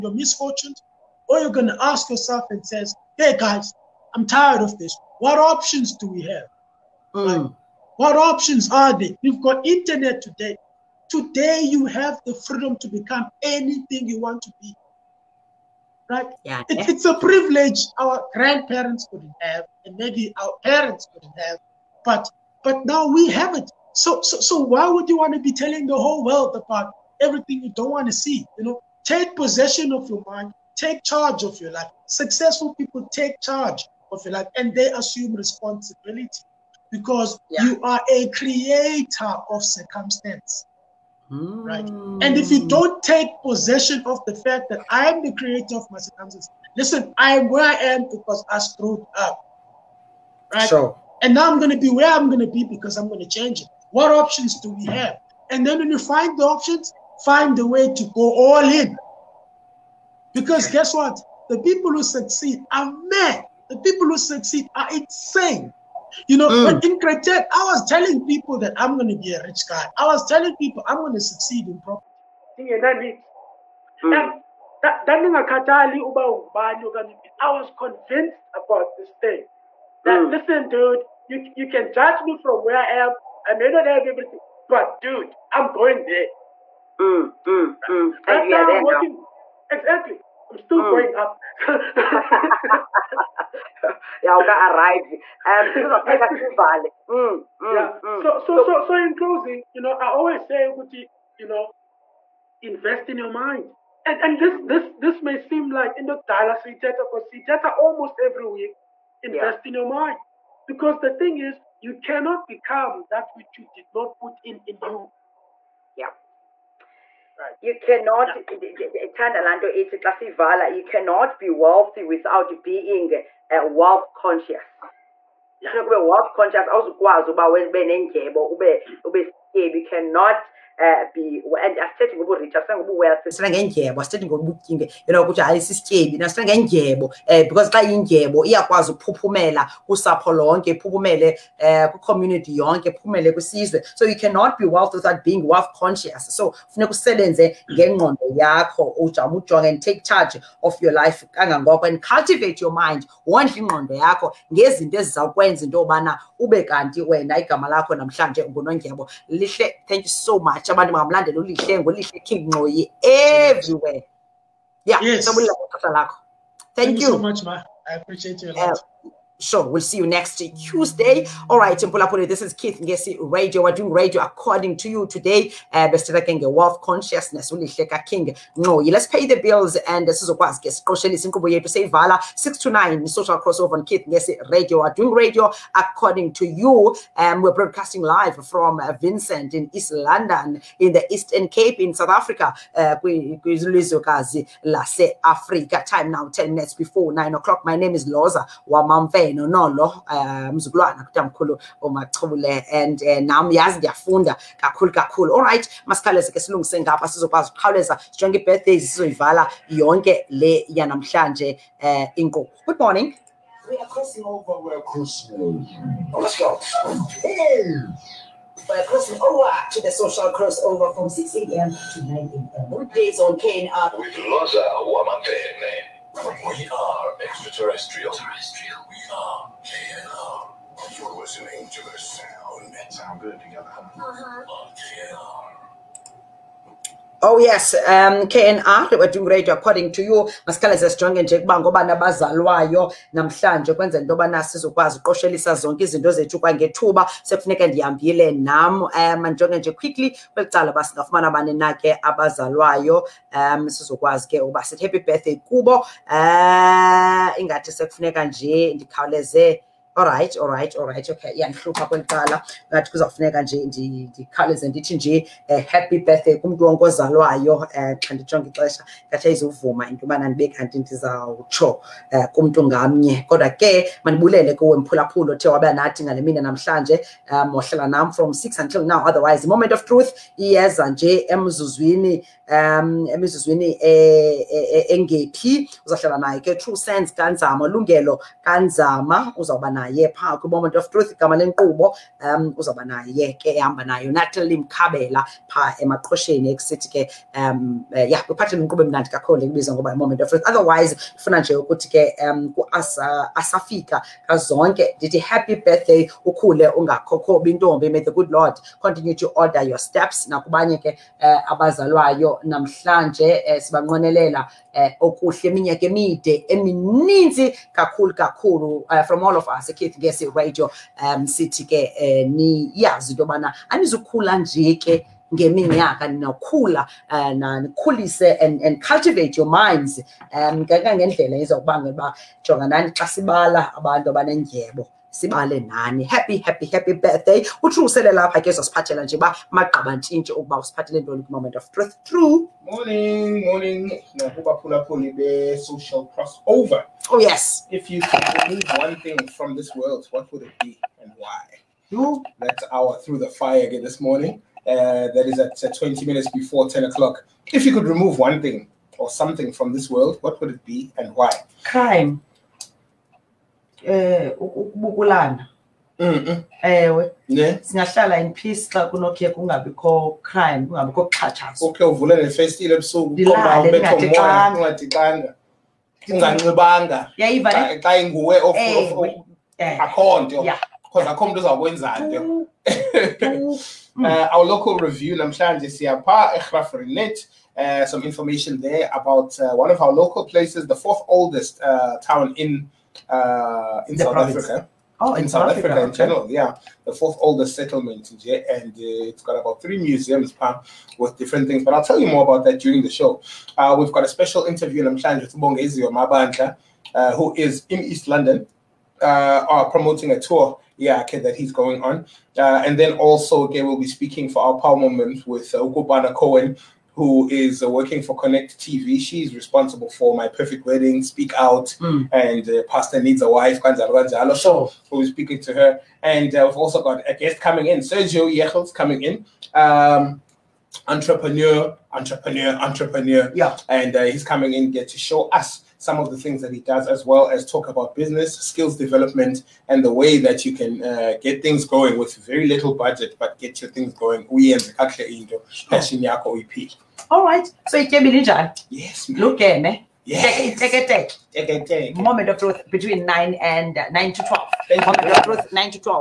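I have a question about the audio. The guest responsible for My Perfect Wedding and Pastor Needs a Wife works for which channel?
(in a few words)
Connect TV.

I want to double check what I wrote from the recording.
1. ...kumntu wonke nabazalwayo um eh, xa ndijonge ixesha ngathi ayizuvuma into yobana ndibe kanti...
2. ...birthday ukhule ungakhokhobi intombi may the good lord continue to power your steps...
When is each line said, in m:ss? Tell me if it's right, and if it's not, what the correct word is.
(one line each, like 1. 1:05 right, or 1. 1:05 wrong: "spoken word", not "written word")
1. 4:26 wrong: "ozalwayo", not "nabazalwayo"
2. 5:05 wrong: "order", not "power".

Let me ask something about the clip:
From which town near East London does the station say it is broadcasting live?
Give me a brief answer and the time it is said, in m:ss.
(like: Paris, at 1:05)
Vincent, at 3:09.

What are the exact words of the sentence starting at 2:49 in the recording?
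Uh, Sure, We'll see you next Tuesday.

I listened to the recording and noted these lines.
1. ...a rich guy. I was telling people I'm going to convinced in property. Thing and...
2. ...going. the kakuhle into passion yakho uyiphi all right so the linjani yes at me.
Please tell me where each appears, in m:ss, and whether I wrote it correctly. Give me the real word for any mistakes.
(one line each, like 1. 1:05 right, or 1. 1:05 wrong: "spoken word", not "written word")
1. 1:09 wrong: "succeed", not "convinced"
2. 7:23 right.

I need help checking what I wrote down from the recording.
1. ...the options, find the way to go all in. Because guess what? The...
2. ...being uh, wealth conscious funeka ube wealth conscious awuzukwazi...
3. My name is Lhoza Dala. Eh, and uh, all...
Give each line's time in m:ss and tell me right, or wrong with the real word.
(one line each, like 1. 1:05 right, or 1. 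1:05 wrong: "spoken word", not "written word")
1. 0:56 right
2. 2:02 right
3. 3:17 wrong: "Wamamfe", not "Dala".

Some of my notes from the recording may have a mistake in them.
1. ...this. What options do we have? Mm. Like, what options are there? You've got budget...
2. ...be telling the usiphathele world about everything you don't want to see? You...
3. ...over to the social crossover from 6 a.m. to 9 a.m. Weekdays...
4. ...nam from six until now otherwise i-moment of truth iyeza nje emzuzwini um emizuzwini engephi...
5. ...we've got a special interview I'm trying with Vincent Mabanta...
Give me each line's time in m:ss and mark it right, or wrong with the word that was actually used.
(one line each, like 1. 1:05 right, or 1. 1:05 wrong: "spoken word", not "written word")
1. 0:04 wrong: "internet", not "budget"
2. 0:25 wrong: "whole", not "usiphathele"
3. 3:39 right
4. 4:37 right
5. 6:43 wrong: "Bongezi", not "Vincent".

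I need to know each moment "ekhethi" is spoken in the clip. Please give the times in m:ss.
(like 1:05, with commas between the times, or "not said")
5:19.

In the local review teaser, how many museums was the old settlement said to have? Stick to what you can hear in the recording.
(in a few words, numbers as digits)
3.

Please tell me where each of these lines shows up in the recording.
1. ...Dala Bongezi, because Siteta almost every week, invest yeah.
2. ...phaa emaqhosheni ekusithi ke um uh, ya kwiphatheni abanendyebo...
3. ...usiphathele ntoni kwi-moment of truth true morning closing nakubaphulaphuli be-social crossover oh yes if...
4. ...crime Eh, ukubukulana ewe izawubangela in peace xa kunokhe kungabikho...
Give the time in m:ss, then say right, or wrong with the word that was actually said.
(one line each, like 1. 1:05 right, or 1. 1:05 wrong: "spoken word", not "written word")
1. 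1:46 wrong: "Siteta", not "Bongezi"
2. 4:55 wrong: "inkqubo", not "abanendyebo"
3. 5:40 wrong: "morning", not "closing"
4. 6:01 wrong: "singahlala", not "izawubangela".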